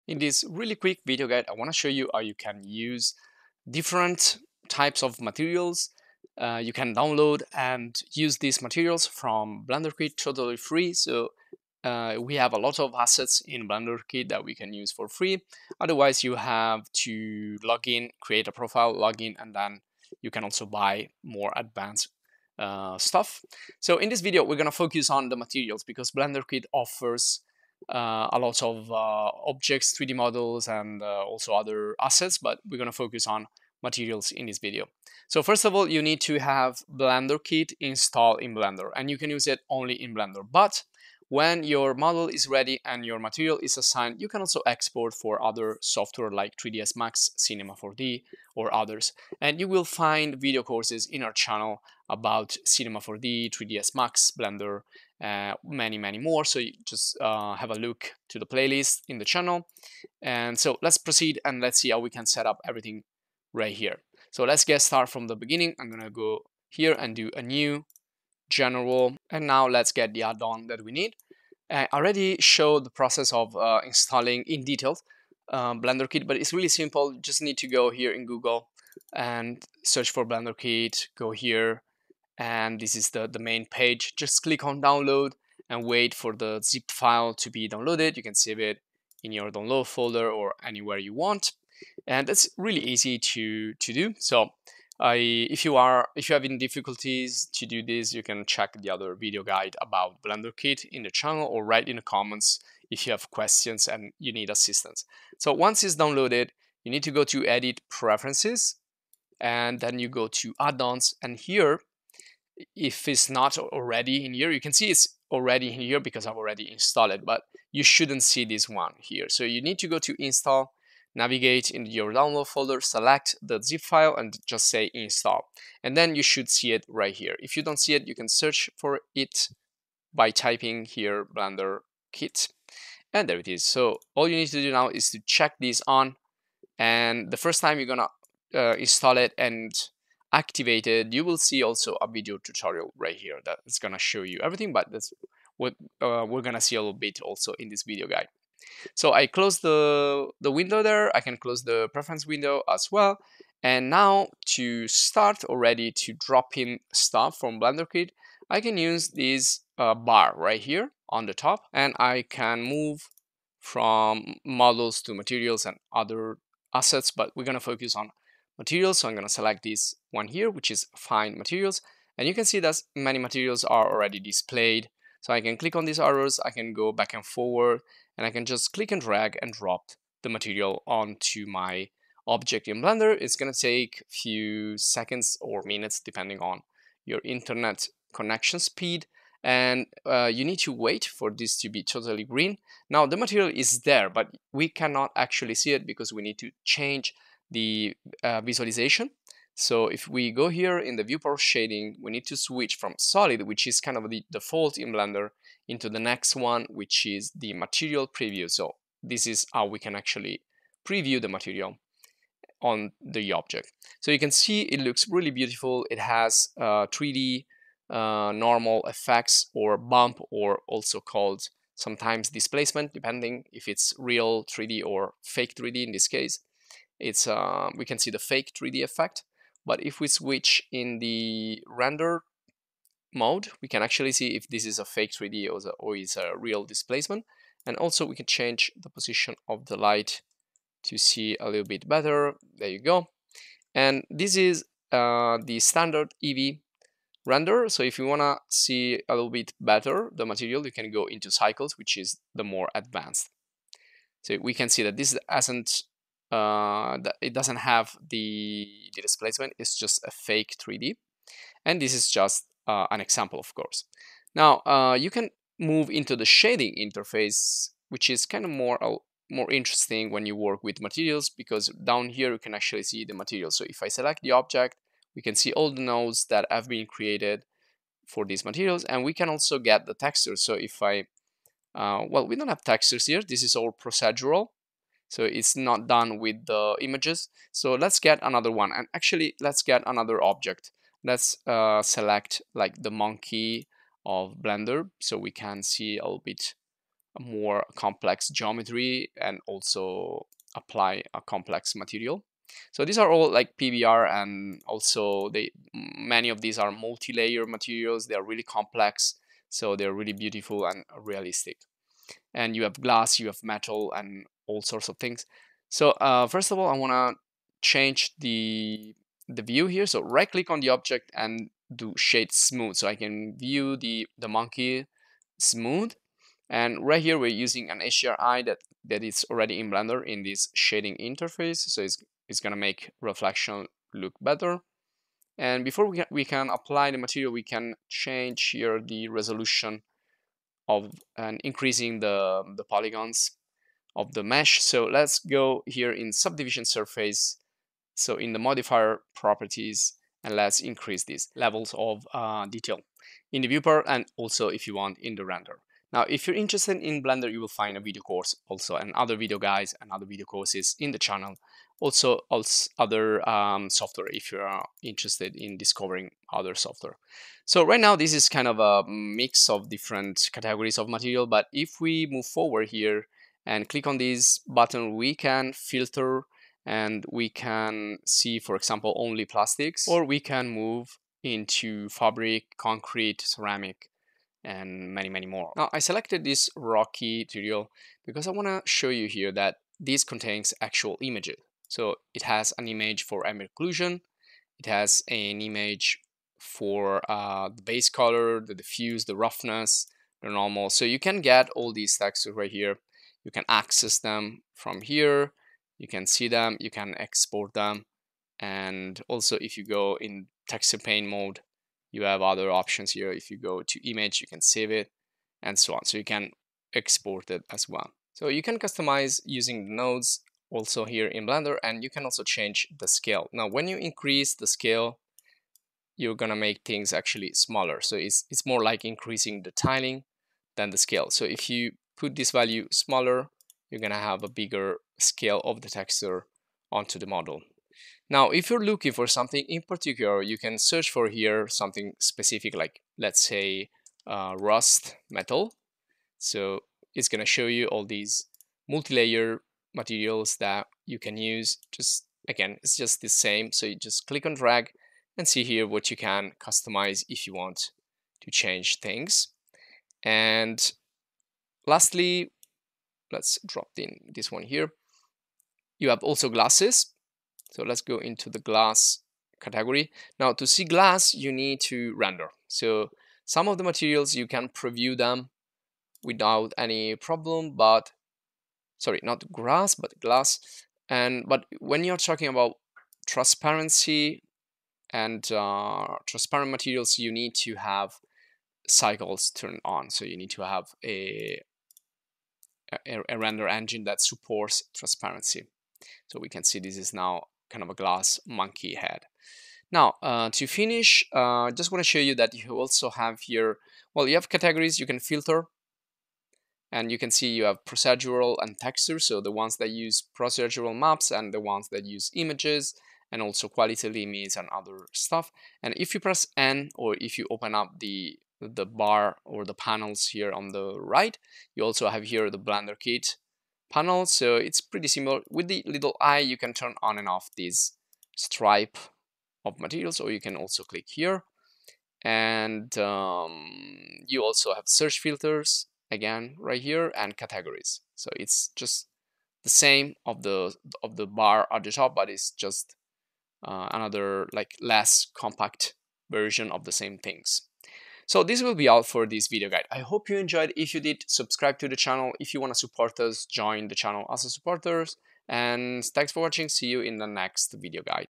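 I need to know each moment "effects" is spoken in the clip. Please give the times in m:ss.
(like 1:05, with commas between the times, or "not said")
3:38, 3:48.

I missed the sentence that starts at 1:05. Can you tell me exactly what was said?
I'm gonna go here and do a new general.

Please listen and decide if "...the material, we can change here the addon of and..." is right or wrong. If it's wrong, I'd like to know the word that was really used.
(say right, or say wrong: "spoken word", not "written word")
wrong: "resolution", not "addon".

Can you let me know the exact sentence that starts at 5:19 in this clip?
So right click on the object and do shade smooth.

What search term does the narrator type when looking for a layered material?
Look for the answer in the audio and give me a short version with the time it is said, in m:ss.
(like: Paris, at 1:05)
Rust metal, at 7:24.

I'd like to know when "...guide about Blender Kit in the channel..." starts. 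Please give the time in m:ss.
1:39.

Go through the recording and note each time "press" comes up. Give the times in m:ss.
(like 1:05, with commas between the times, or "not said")
8:35.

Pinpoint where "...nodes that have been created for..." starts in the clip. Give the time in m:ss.
4:35.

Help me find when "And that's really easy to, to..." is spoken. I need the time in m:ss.
1:32.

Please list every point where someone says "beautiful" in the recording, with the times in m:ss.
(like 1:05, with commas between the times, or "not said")
3:35, 5:10.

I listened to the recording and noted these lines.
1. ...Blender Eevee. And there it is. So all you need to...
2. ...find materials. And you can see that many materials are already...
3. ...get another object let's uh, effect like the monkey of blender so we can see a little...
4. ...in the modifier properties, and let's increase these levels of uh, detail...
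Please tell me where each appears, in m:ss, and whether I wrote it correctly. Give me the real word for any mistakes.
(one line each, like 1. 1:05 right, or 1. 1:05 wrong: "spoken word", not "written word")
1. 2:11 wrong: "Kit", not "Eevee"
2. 2:50 right
3. 4:49 wrong: "select", not "effect"
4. 5:48 right.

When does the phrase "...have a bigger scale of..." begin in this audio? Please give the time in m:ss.
7:14.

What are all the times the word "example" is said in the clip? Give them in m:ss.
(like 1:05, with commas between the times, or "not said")
4:23, 6:18.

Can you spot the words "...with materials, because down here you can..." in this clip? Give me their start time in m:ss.
4:30.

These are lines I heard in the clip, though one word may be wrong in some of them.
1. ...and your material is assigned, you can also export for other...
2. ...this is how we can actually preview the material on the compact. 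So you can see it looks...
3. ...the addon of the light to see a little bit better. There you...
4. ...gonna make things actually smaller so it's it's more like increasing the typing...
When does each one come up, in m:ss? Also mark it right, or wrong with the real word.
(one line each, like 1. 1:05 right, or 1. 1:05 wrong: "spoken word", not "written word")
1. 0:42 right
2. 3:29 wrong: "object", not "compact"
3. 3:58 wrong: "position", not "addon"
4. 7:06 wrong: "tiling", not "typing".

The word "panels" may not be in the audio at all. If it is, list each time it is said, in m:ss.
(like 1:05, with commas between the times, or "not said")
8:39, 8:43.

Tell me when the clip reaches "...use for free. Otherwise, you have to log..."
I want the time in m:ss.
0:14.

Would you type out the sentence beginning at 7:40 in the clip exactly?
And Lastly, let's drop in this one here.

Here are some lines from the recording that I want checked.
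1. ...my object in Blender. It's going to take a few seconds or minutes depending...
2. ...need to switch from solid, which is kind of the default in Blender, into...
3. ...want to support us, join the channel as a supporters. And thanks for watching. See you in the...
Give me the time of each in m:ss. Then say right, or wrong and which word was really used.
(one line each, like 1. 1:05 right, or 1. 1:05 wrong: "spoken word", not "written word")
1. 3:01 right
2. 3:22 right
3. 9:12 right.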